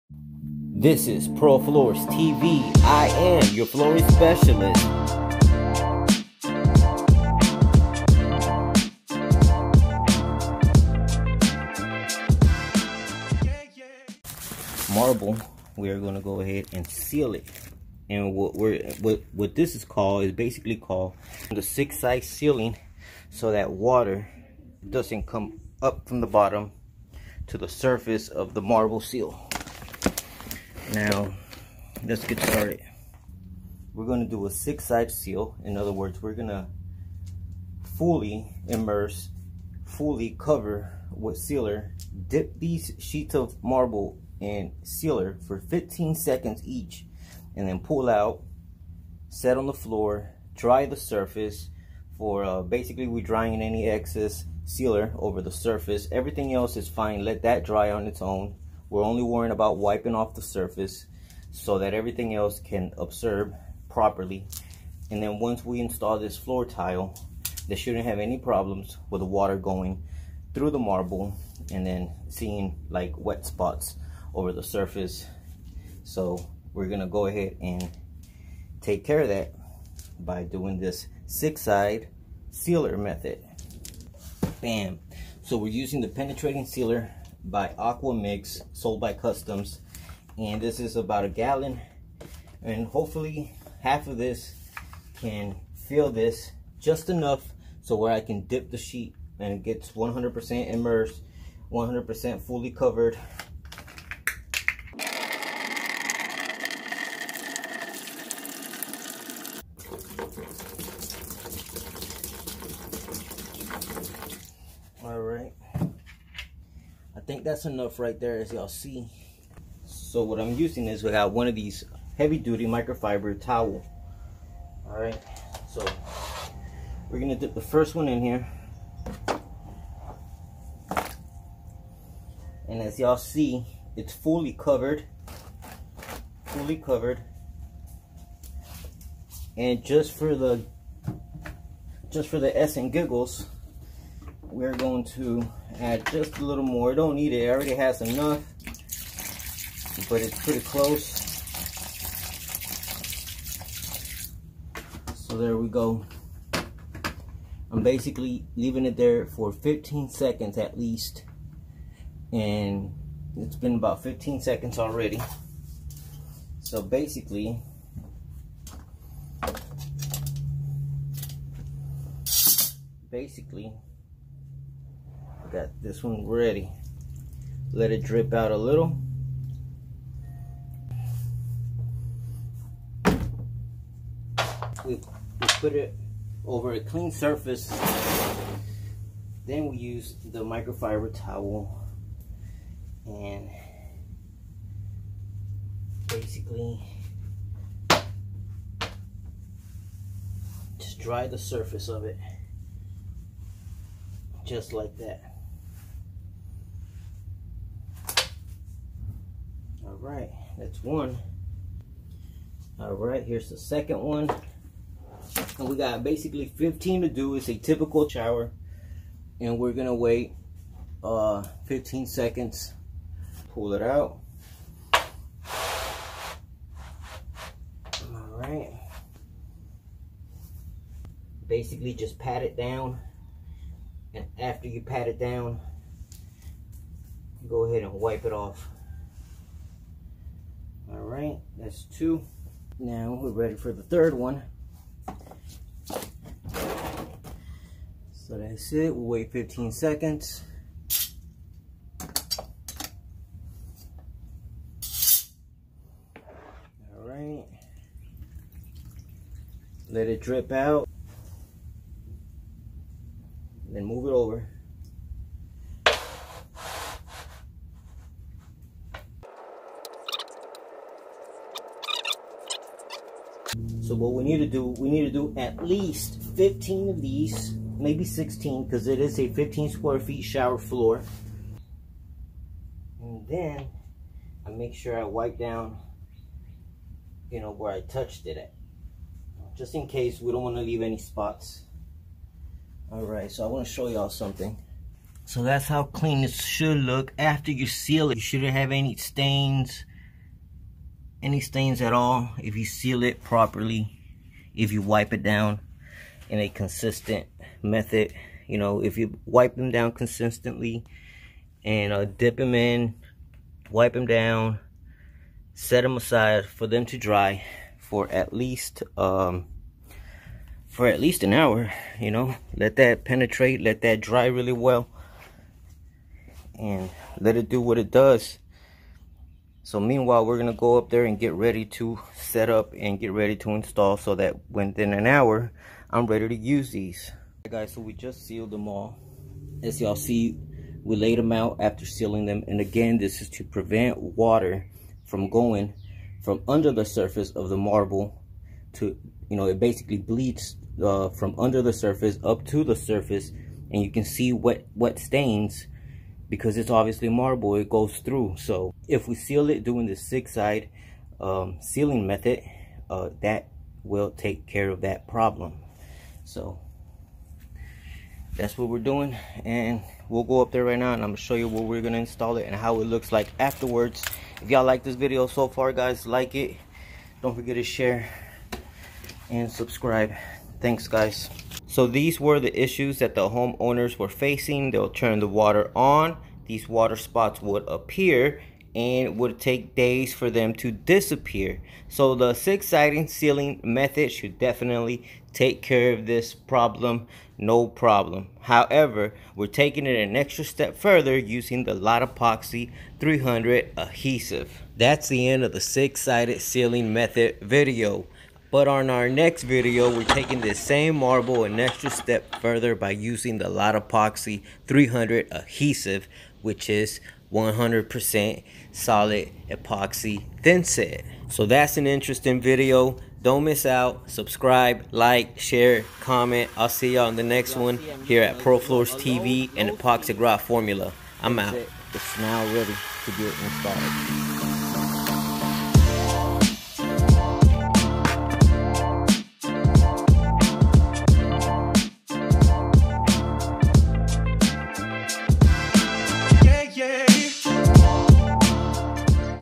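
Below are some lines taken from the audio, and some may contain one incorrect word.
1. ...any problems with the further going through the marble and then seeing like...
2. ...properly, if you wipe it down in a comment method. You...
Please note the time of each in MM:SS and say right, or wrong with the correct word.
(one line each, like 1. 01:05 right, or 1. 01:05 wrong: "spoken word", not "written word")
1. 01:08 wrong: "water", not "further"
2. 05:03 wrong: "consistent", not "comment".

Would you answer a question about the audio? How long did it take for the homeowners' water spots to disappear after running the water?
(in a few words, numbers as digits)
days.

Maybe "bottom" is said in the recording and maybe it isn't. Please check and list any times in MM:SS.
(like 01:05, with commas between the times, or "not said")
00:26.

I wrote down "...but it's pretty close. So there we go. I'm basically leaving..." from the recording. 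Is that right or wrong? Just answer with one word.
right.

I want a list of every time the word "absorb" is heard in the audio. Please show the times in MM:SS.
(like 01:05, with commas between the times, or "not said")
01:02.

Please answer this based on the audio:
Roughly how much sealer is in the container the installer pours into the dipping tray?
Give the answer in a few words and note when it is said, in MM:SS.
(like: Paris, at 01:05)
a gallon, at 01:30.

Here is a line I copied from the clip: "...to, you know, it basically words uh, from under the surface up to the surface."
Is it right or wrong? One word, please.
wrong.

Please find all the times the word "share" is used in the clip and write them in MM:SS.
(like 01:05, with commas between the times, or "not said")
06:17, 07:05.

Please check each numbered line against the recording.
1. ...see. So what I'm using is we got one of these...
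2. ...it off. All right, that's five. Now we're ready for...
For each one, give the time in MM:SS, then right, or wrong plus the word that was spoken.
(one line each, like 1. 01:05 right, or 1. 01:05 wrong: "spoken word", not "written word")
1. 01:58 right
2. 03:58 wrong: "two", not "five".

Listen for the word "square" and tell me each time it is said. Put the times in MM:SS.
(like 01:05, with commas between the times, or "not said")
04:39.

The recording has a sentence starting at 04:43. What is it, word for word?
And then I make sure I wipe down, you know, where I touched it at.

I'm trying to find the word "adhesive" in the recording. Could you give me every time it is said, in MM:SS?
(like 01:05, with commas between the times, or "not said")
06:43, 06:55.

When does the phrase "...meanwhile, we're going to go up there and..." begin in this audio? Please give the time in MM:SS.
05:29.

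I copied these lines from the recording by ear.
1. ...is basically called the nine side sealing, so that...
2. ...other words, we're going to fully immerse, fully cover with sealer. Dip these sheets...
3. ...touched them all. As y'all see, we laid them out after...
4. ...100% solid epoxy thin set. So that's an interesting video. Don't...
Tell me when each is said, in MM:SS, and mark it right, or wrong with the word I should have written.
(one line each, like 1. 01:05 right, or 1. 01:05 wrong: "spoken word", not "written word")
1. 00:20 wrong: "six", not "nine"
2. 00:35 right
3. 05:38 wrong: "sealed", not "touched"
4. 06:57 right.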